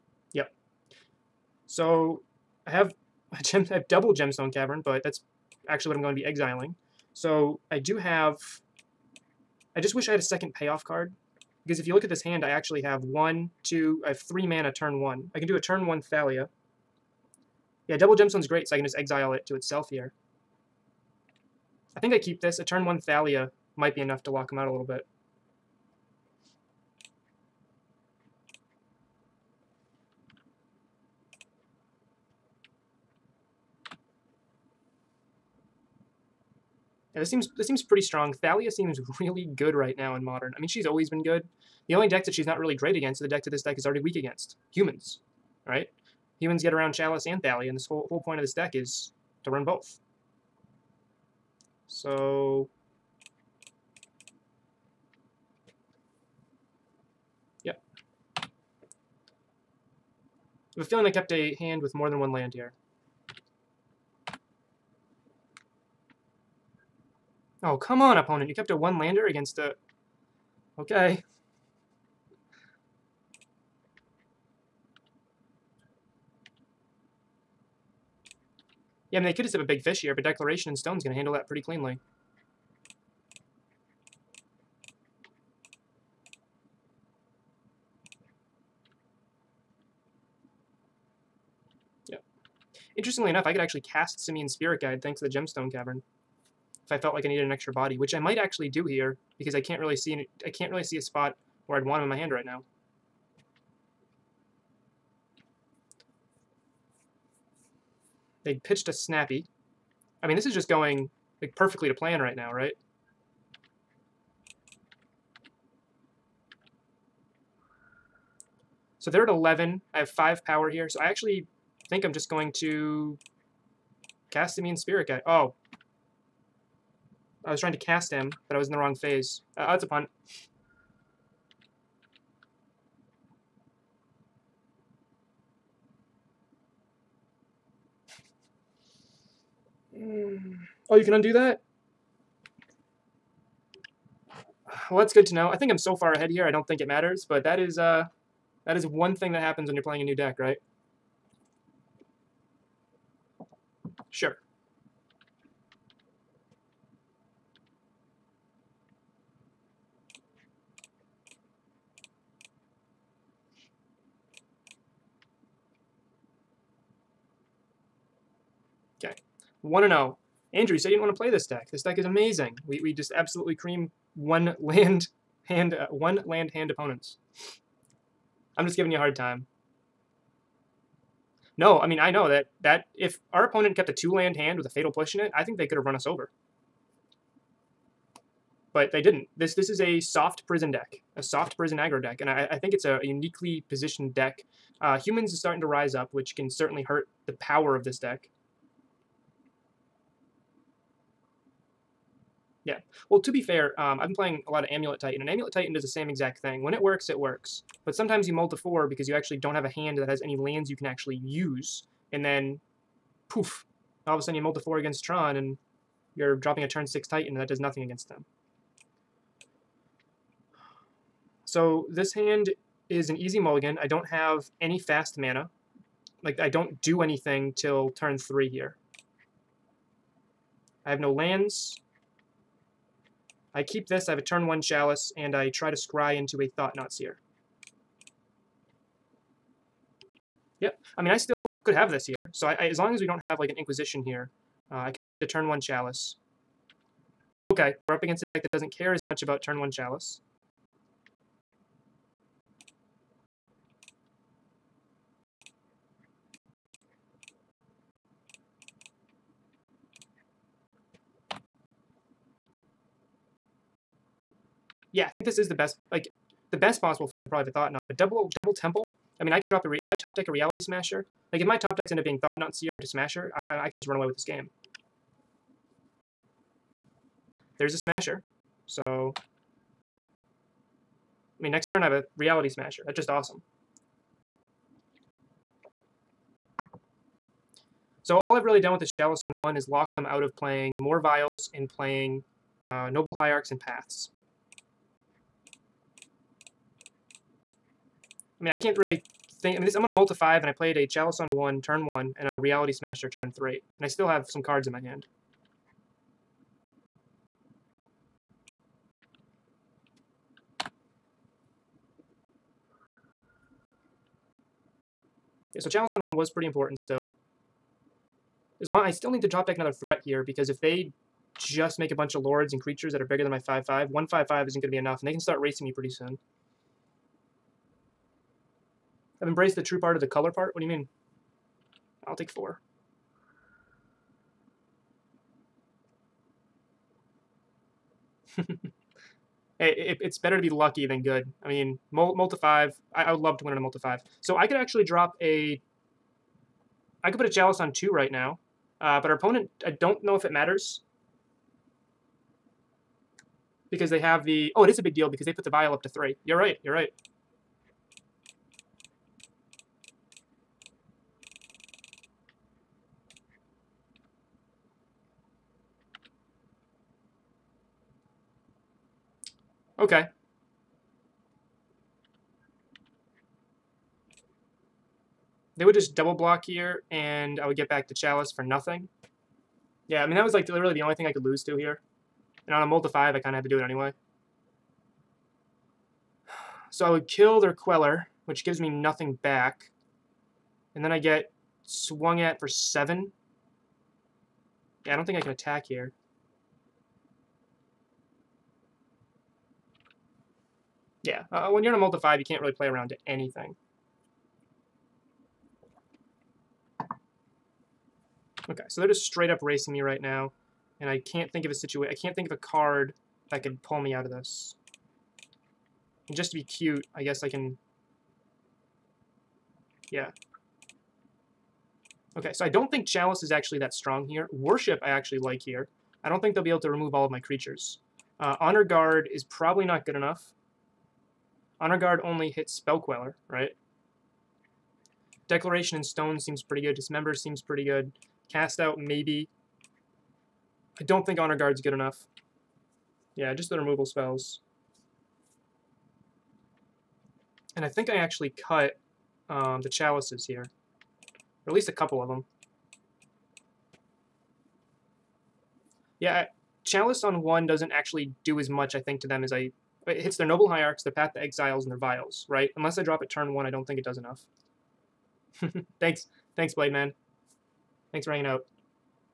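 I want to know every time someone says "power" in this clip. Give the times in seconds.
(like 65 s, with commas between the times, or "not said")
120 s, 197 s.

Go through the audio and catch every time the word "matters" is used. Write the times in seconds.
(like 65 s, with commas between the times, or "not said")
146 s, 350 s.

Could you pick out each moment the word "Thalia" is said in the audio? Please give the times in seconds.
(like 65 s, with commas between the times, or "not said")
16 s, 22 s, 38 s, 47 s.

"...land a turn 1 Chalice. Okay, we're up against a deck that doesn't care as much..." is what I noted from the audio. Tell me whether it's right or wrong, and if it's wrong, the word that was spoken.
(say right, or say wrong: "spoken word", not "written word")
right.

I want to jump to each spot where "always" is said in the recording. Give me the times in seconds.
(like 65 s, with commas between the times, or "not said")
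40 s.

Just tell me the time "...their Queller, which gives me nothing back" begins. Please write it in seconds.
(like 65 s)
387 s.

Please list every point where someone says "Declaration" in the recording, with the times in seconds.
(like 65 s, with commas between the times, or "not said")
80 s, 435 s.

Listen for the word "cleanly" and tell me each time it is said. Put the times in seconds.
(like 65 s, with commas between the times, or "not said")
81 s.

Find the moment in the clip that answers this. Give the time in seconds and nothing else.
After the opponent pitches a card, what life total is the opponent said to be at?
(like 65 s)
119 s.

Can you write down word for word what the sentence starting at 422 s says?
Okay, so I don't think Chalice is actually that strong here.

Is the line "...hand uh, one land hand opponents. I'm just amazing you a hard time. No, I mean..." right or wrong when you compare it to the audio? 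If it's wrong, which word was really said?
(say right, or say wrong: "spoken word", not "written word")
wrong: "giving", not "amazing".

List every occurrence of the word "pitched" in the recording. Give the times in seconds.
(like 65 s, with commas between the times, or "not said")
108 s.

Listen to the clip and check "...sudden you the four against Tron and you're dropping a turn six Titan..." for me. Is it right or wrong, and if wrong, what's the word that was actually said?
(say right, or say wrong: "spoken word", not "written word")
right.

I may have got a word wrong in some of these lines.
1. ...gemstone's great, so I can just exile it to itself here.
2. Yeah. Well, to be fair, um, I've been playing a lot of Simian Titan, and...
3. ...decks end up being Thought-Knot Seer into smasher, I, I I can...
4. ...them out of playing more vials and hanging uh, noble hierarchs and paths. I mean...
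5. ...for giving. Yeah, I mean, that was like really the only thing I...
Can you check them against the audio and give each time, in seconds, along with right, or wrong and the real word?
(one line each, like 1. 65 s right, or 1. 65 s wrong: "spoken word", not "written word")
1. 18 s right
2. 202 s wrong: "Amulet", not "Simian"
3. 271 s right
4. 289 s wrong: "playing", not "hanging"
5. 378 s wrong: "nothing", not "giving".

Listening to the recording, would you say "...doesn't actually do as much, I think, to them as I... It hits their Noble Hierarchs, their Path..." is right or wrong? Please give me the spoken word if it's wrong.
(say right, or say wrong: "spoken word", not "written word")
right.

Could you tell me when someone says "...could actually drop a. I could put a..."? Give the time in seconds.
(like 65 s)
344 s.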